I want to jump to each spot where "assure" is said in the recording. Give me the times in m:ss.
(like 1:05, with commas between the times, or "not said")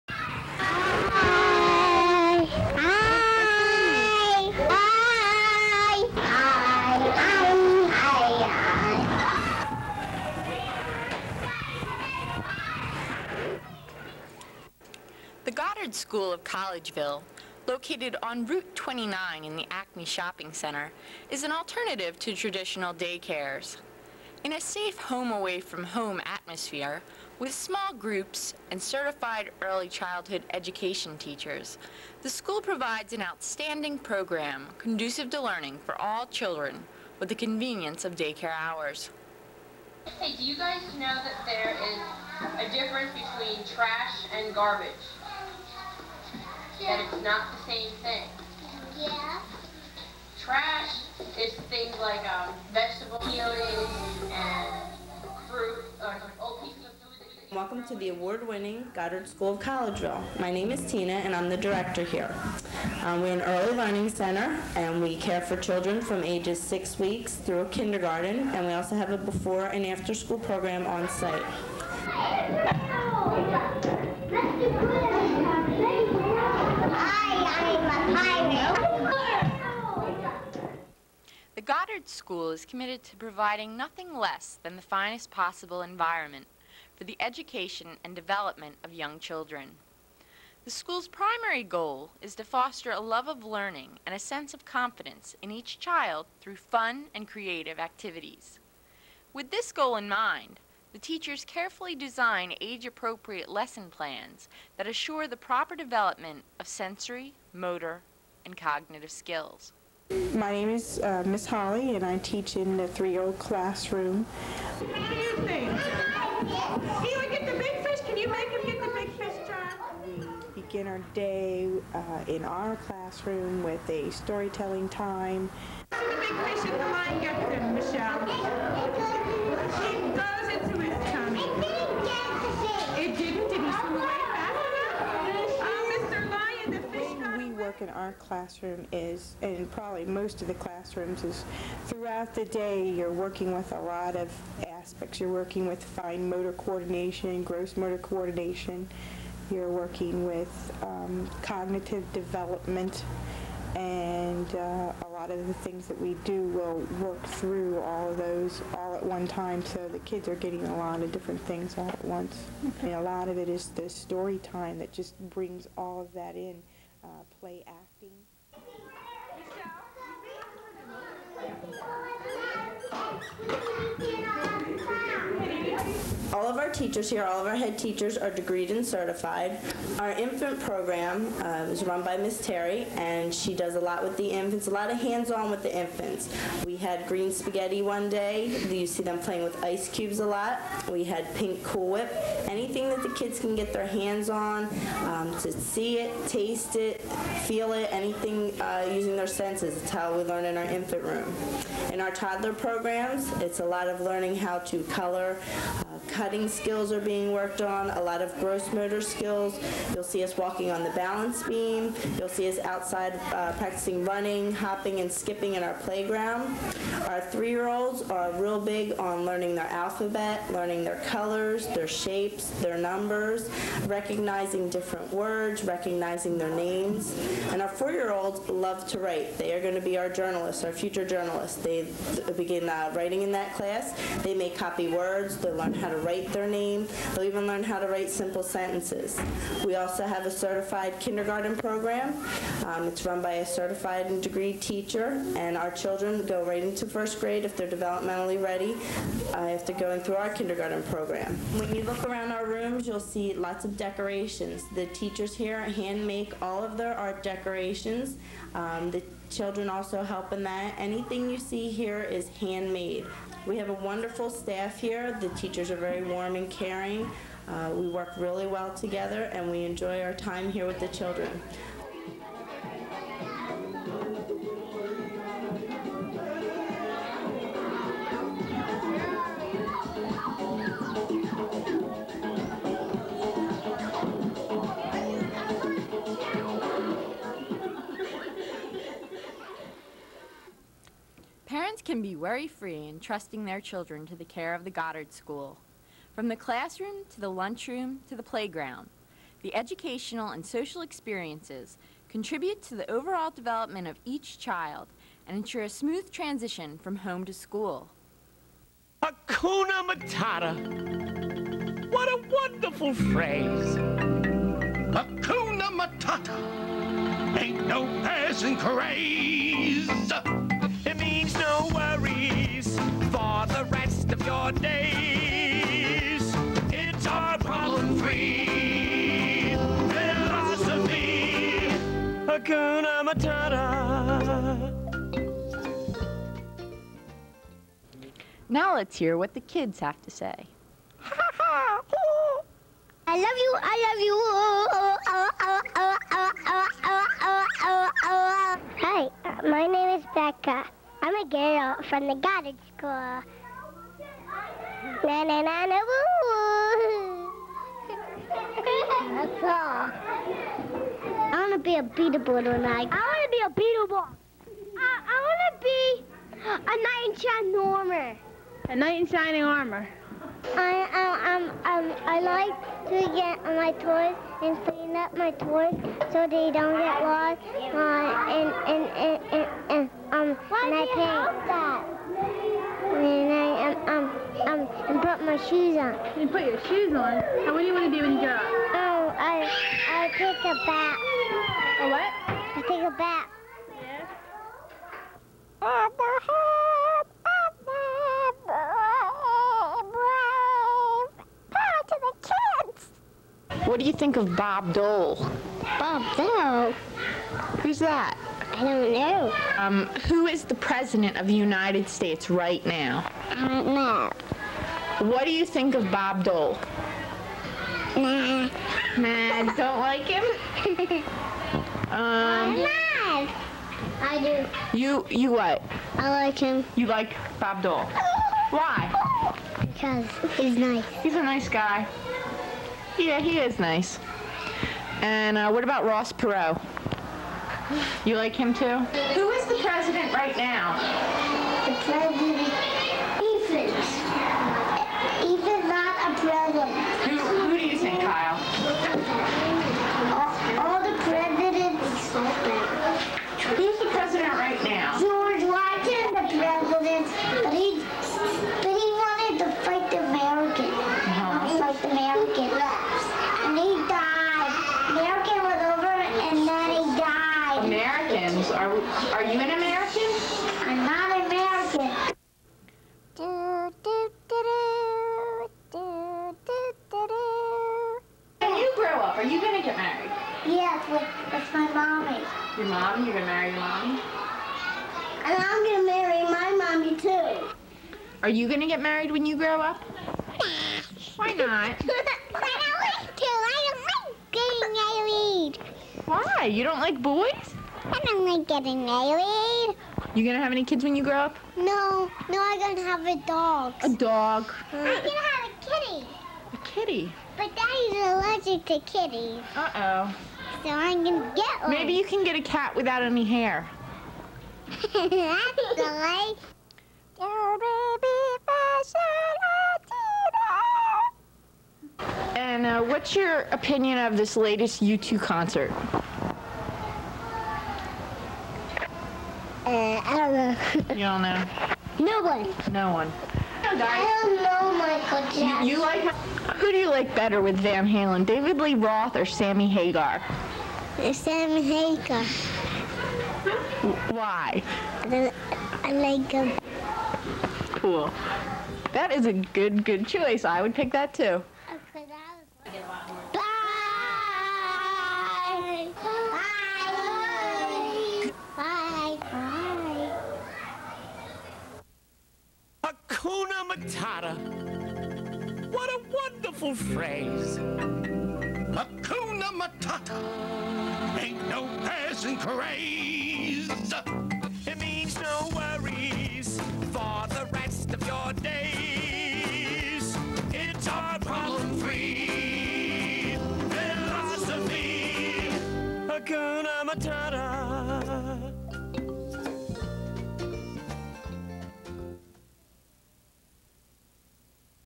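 1:44.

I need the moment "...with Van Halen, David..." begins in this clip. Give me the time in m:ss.
8:57.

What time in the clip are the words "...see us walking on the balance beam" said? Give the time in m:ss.
3:30.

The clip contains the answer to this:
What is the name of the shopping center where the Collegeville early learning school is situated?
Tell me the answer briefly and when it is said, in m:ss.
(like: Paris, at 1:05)
Acme Shopping Center, at 0:19.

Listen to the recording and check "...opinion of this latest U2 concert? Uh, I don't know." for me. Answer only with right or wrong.
right.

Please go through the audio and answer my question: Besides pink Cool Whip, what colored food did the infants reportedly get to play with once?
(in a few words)
green spaghetti.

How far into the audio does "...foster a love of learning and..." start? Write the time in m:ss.
1:32.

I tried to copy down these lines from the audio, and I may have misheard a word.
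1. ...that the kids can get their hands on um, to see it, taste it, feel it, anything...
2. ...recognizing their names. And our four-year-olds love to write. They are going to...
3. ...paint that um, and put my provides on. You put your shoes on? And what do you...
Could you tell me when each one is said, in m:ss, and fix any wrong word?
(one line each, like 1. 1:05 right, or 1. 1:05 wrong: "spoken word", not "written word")
1. 3:12 right
2. 3:45 right
3. 6:20 wrong: "shoes", not "provides".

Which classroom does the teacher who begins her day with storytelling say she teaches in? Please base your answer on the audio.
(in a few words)
3-0 classroom.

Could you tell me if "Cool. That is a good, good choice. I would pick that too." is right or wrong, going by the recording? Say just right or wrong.
right.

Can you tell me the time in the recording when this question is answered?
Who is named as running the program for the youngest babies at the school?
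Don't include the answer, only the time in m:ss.
3:02.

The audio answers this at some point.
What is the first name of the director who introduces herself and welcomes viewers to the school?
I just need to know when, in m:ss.
1:00.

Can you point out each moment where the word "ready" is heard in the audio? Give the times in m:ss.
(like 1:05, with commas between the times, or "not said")
4:08.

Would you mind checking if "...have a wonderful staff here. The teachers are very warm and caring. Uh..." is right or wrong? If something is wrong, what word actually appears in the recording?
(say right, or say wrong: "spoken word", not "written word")
right.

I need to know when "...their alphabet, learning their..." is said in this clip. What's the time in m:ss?
3:39.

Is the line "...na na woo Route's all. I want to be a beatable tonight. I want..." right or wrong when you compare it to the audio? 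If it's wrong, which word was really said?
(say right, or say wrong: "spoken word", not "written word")
wrong: "That", not "Route".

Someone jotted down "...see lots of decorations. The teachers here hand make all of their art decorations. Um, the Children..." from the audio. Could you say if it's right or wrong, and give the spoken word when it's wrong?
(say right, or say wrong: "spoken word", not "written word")
right.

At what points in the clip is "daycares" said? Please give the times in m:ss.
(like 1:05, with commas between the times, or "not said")
0:22, 0:38.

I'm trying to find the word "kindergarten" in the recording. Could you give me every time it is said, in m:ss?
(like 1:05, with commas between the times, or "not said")
1:07, 4:00, 4:10.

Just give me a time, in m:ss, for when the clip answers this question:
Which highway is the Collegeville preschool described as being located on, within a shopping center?
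0:18.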